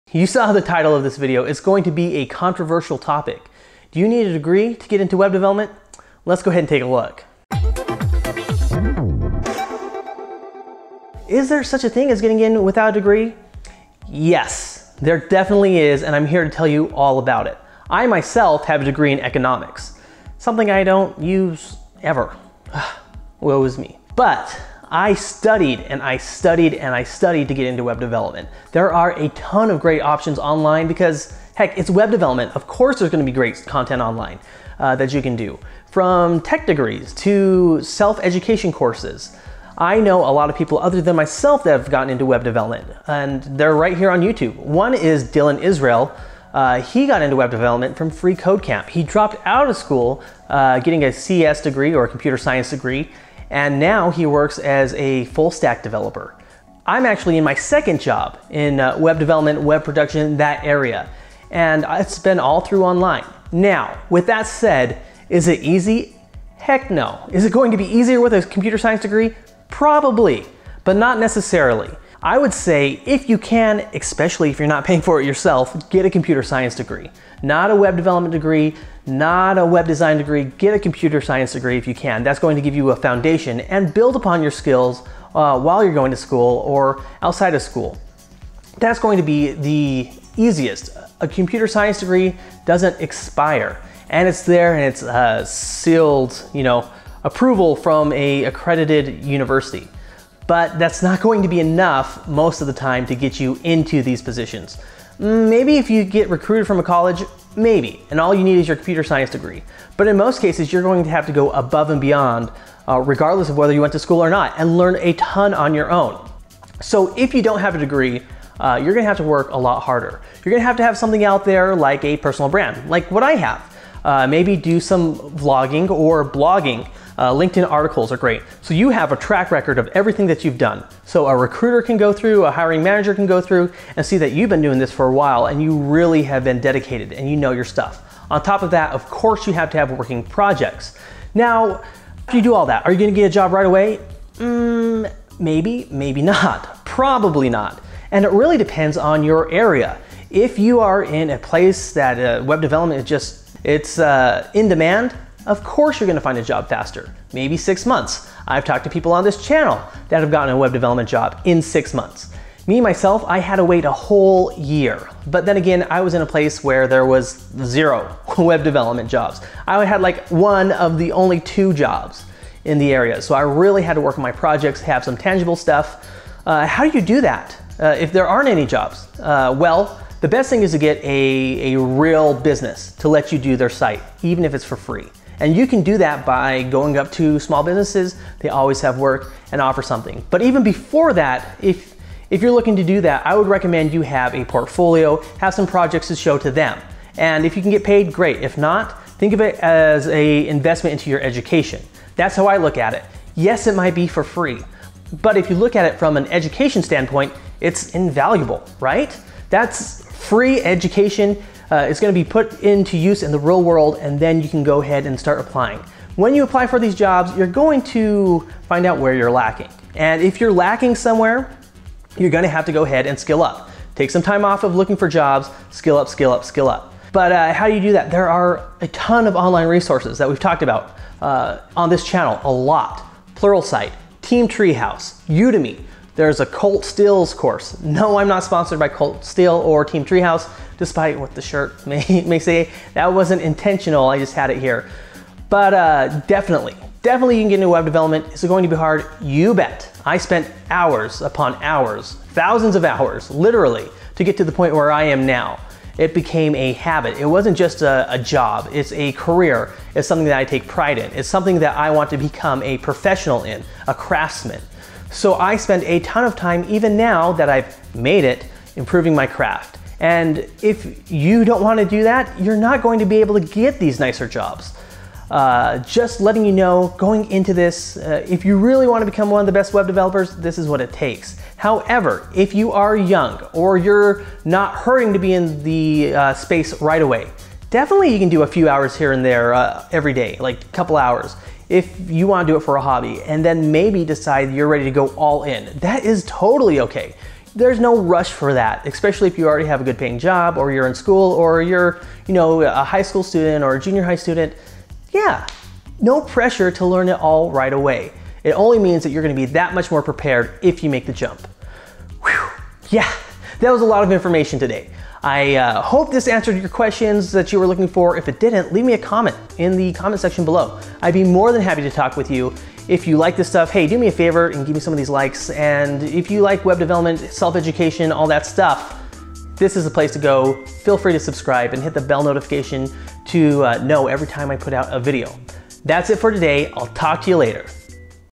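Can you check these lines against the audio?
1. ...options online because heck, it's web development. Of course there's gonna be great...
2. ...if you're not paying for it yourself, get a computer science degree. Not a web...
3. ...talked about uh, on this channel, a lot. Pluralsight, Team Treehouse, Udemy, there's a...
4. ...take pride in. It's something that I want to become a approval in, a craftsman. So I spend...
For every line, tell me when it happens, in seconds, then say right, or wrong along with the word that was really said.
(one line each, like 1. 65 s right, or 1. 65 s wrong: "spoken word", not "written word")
1. 30 s right
2. 74 s right
3. 230 s right
4. 260 s wrong: "professional", not "approval".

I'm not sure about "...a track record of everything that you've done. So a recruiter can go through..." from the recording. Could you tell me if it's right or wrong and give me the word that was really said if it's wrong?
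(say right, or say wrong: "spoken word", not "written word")
right.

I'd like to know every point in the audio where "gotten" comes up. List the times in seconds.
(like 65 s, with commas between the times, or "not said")
41 s, 160 s.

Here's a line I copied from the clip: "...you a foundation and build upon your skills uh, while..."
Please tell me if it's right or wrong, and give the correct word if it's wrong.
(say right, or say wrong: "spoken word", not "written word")
right.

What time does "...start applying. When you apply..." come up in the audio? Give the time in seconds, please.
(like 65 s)
215 s.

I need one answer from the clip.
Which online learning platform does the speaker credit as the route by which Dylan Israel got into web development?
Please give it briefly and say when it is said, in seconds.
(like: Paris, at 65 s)
Free Code Camp, at 48 s.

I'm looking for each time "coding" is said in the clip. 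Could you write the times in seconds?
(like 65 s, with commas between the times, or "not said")
not said.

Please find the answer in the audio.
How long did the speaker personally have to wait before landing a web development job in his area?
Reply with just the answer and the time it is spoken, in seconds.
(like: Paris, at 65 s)
A whole year, at 163 s.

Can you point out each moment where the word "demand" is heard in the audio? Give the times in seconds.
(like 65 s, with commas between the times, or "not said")
154 s.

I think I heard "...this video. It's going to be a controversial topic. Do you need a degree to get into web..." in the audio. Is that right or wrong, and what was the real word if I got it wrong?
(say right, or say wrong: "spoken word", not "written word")
right.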